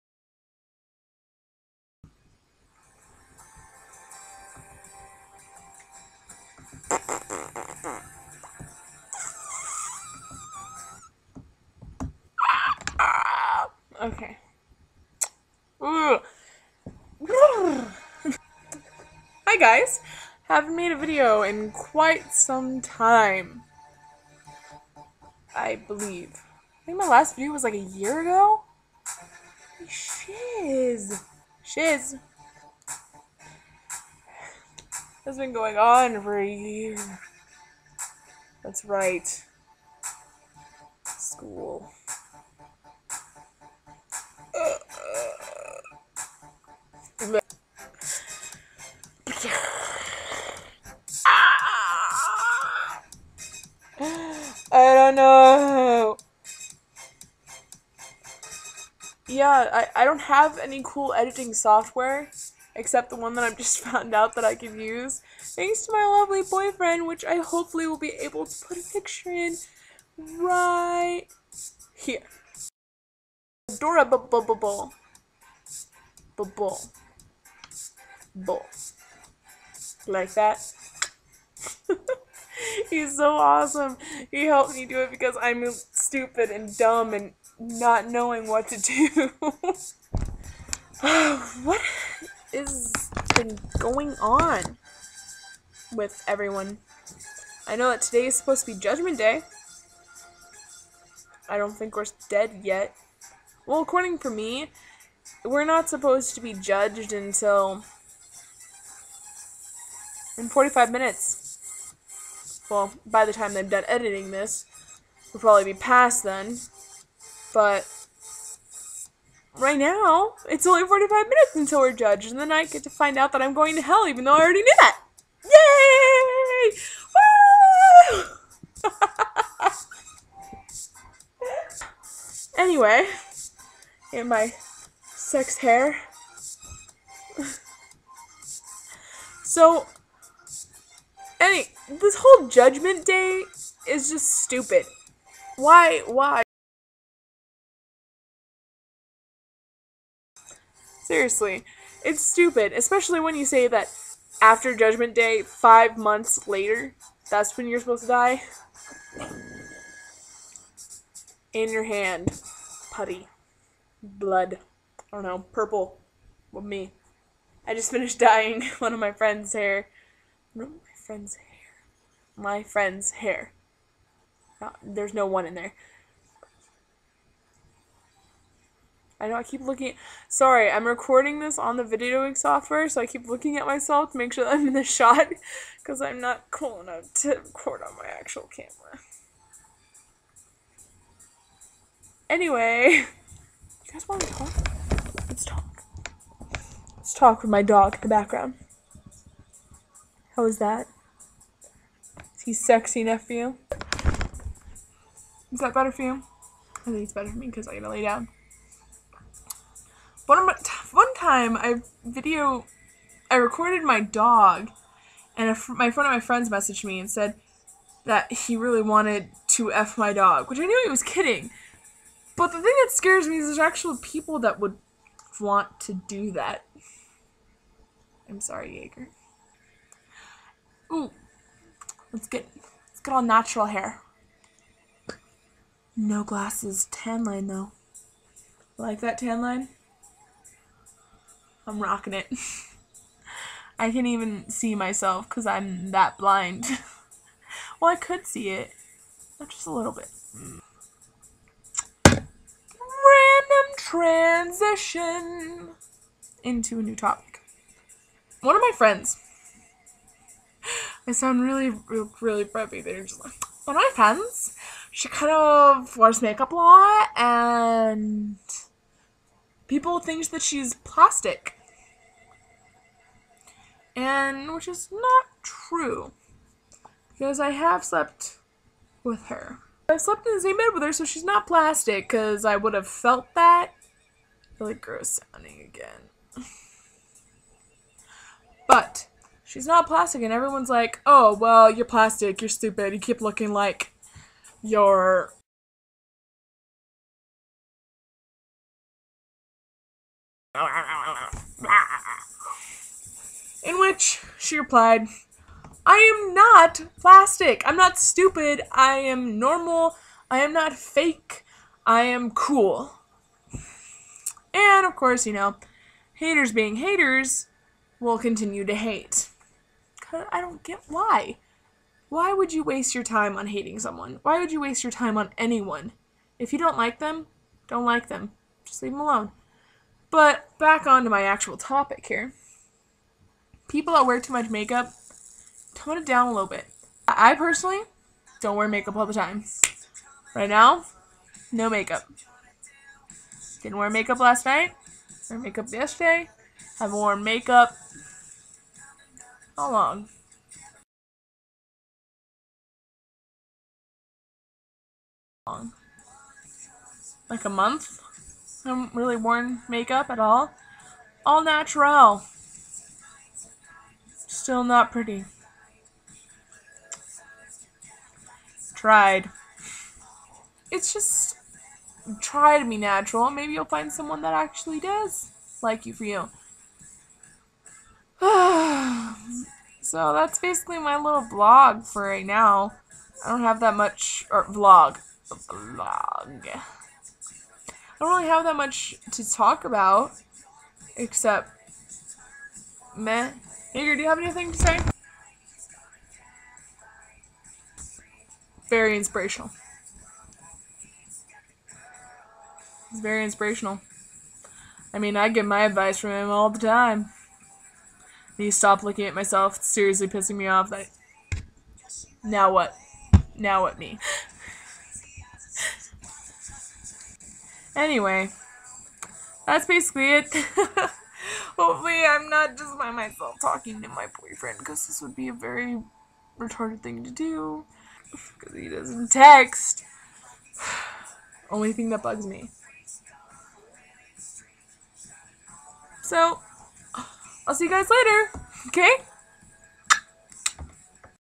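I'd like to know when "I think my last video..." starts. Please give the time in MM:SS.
00:26.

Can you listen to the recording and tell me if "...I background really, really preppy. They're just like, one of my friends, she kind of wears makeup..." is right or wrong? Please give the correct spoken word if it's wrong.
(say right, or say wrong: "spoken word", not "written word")
wrong: "sound", not "background".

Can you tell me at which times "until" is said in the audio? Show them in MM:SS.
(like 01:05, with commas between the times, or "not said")
01:47, 02:01.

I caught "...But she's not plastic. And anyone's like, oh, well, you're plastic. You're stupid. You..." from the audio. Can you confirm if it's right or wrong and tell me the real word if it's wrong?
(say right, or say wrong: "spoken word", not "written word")
wrong: "everyone", not "anyone".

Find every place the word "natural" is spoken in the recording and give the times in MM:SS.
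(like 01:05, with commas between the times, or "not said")
03:53, 06:01, 06:12.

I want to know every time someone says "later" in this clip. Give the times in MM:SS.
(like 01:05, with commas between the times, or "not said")
02:36, 07:17.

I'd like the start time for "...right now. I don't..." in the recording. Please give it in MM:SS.
06:22.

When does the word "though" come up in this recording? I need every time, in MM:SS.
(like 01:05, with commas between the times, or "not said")
02:04, 03:57.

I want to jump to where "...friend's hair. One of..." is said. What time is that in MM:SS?
02:49.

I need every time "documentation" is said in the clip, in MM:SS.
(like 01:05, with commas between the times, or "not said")
not said.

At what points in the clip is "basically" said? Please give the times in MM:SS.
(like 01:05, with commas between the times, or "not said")
06:20, 06:59.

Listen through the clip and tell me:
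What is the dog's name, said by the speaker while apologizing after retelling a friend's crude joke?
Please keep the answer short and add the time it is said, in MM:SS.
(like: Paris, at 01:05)
Jaeger, at 03:48.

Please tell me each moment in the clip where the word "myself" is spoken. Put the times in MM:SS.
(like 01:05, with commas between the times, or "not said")
03:03, 04:04, 06:49, 07:02.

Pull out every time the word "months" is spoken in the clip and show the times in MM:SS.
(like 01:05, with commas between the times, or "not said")
02:35, 05:57.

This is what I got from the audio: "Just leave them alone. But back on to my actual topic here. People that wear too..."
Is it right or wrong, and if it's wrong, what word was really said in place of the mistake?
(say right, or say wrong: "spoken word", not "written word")
right.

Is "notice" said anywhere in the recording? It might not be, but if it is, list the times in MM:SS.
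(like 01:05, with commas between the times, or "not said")
not said.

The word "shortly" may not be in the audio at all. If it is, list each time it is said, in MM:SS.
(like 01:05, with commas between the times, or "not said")
not said.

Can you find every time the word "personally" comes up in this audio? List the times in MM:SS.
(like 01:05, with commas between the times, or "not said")
05:37.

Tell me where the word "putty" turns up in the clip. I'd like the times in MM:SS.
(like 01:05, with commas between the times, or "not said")
02:42.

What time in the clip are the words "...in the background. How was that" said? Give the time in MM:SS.
03:17.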